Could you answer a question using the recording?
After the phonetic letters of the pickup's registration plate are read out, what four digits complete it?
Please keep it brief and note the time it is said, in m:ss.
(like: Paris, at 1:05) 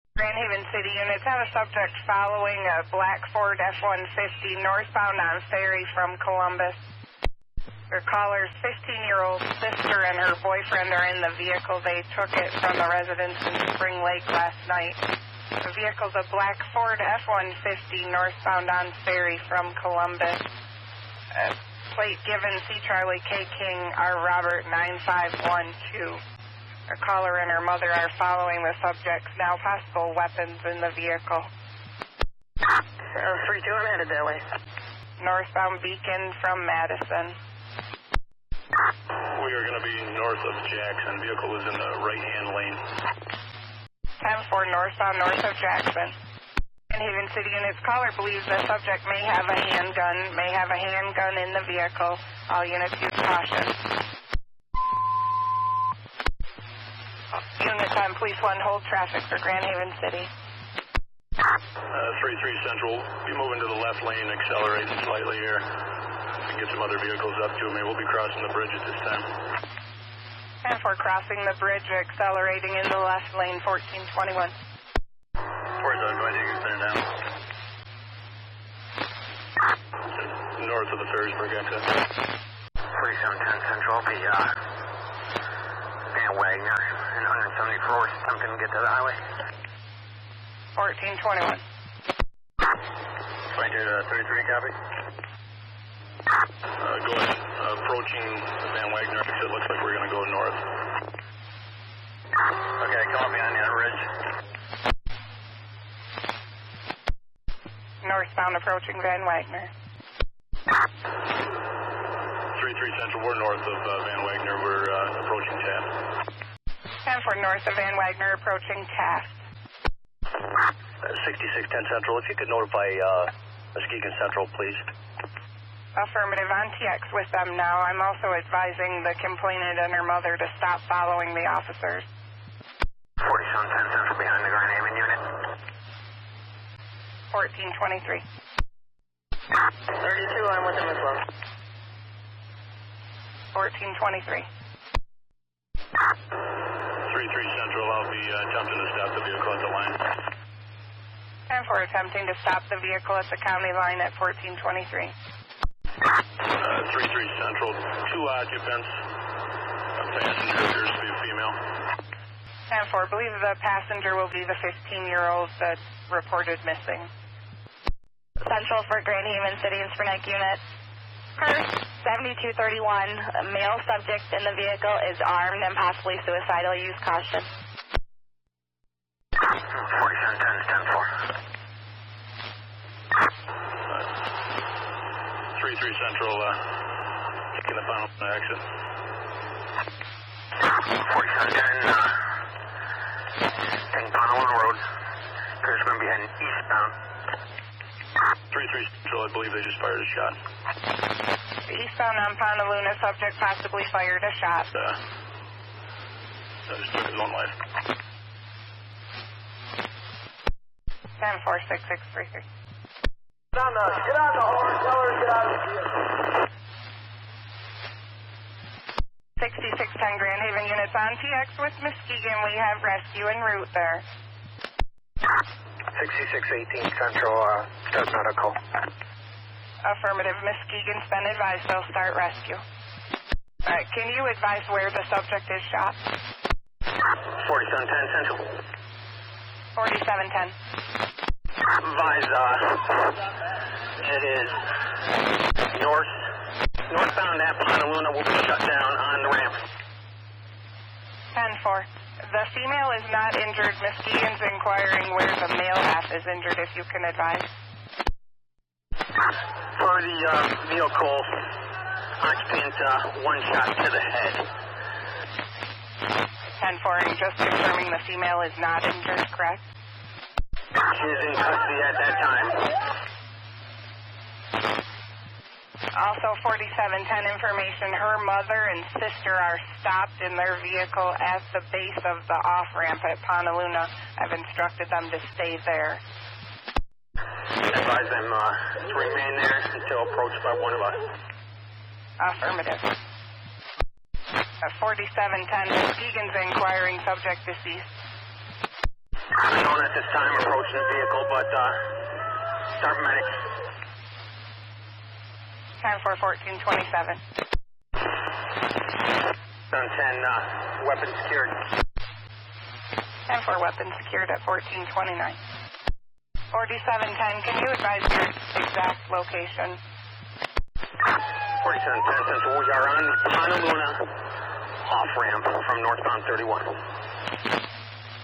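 9512, at 0:24.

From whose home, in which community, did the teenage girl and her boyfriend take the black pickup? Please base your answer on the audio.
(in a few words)
Spring Lake.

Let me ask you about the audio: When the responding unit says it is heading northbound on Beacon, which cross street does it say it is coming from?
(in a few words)
Madison.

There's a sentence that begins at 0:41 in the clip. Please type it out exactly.
Vehicle is in the right hand lane.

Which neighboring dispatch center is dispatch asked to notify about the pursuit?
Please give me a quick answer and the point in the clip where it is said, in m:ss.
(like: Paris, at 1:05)
Muskegon Central, at 2:03.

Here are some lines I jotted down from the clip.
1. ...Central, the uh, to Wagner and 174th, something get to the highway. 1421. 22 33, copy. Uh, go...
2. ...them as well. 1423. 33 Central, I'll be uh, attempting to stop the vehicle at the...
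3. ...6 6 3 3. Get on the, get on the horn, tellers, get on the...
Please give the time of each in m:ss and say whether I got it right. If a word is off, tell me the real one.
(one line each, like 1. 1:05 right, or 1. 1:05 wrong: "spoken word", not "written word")
1. 1:23 right
2. 2:20 right
3. 3:31 right.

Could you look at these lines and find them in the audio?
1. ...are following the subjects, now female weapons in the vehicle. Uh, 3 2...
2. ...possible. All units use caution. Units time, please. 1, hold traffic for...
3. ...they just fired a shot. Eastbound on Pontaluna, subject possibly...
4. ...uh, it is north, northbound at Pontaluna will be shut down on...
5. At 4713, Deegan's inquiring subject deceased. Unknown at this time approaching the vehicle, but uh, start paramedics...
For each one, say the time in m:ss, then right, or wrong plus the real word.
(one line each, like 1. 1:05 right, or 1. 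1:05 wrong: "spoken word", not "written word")
1. 0:27 wrong: "possible", not "female"
2. 0:51 wrong: "vehicle", not "possible"
3. 3:19 right
4. 4:02 right
5. 4:54 wrong: "4710", not "4713".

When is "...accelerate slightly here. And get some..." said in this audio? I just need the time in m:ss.
1:04.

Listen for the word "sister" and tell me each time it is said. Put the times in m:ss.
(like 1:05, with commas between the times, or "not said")
0:09, 4:39.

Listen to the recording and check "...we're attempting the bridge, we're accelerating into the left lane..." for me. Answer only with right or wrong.
wrong.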